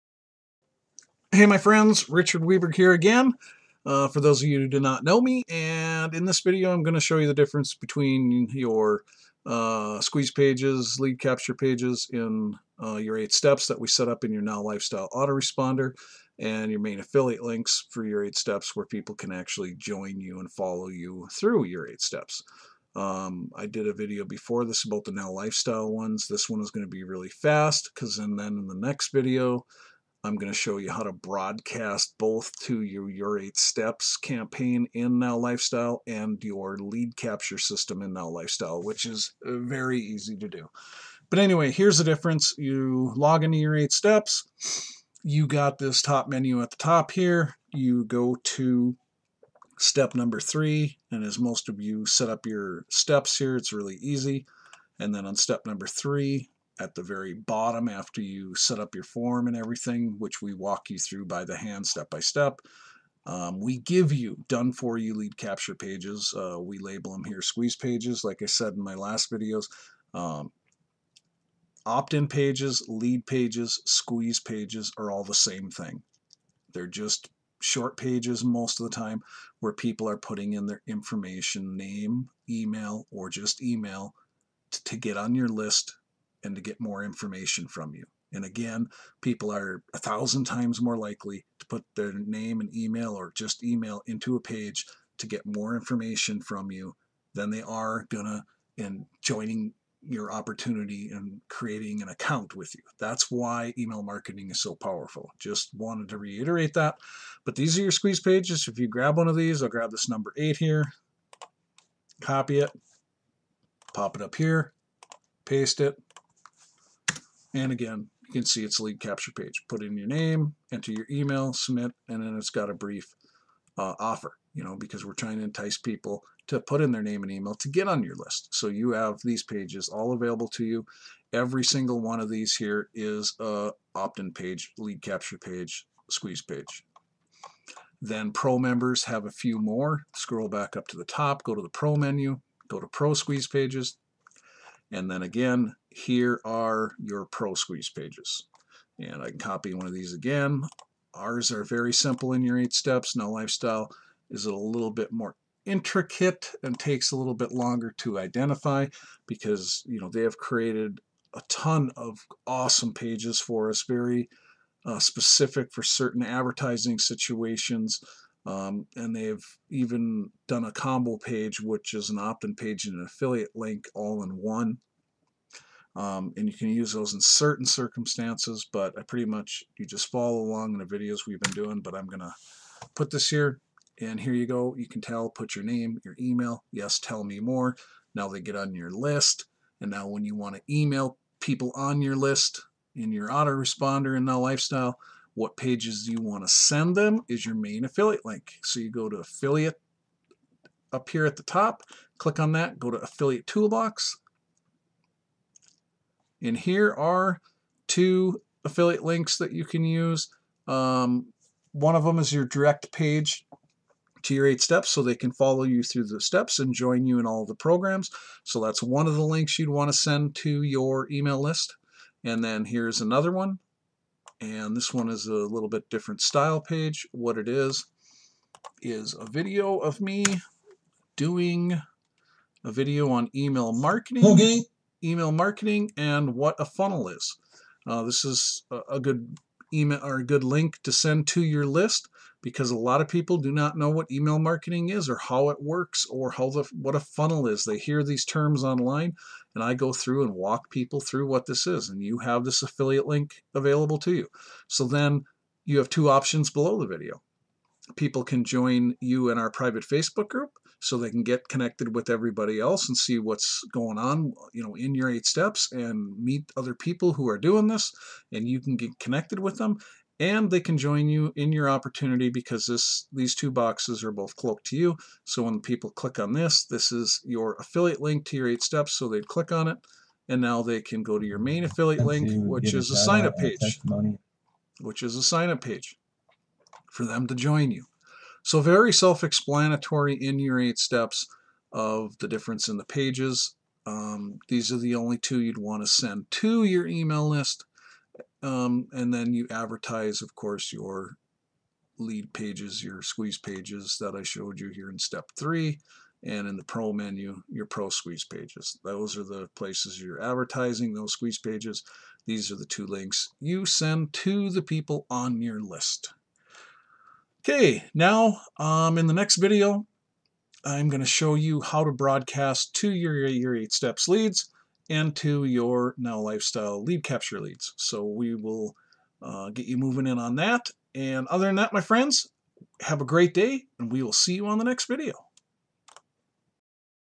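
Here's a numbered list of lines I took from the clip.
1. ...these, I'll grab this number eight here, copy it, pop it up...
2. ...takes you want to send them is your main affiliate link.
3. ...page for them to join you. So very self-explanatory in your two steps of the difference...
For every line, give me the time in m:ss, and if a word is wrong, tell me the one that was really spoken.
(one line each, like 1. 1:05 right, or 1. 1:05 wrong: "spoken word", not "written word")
1. 1:49 right
2. 3:15 wrong: "pages", not "takes"
3. 4:45 wrong: "eight", not "two".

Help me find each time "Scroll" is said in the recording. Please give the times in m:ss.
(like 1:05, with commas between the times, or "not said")
2:20.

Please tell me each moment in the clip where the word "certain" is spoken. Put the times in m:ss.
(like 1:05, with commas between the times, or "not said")
2:45, 2:57.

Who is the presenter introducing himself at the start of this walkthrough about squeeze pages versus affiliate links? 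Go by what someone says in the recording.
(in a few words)
Richard Weberg.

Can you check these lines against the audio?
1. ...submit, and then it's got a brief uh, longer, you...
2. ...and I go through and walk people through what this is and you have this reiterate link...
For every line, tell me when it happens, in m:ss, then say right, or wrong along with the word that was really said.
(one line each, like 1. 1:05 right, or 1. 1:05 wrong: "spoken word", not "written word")
1. 2:01 wrong: "offer", not "longer"
2. 4:09 wrong: "affiliate", not "reiterate".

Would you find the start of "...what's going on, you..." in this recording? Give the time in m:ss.
4:23.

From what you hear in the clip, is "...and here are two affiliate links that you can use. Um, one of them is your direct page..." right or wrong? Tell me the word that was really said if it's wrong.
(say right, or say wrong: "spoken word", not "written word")
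right.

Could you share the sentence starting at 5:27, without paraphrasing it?
So we will uh, get you moving in on that.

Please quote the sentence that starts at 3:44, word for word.
And this one is a little bit different style page.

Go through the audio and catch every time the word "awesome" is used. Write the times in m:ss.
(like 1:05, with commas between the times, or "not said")
2:42.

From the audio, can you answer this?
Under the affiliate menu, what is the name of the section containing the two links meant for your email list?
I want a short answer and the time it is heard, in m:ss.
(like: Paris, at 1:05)
affiliate toolbox, at 3:22.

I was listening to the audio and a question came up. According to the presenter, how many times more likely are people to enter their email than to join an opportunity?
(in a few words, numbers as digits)
1000.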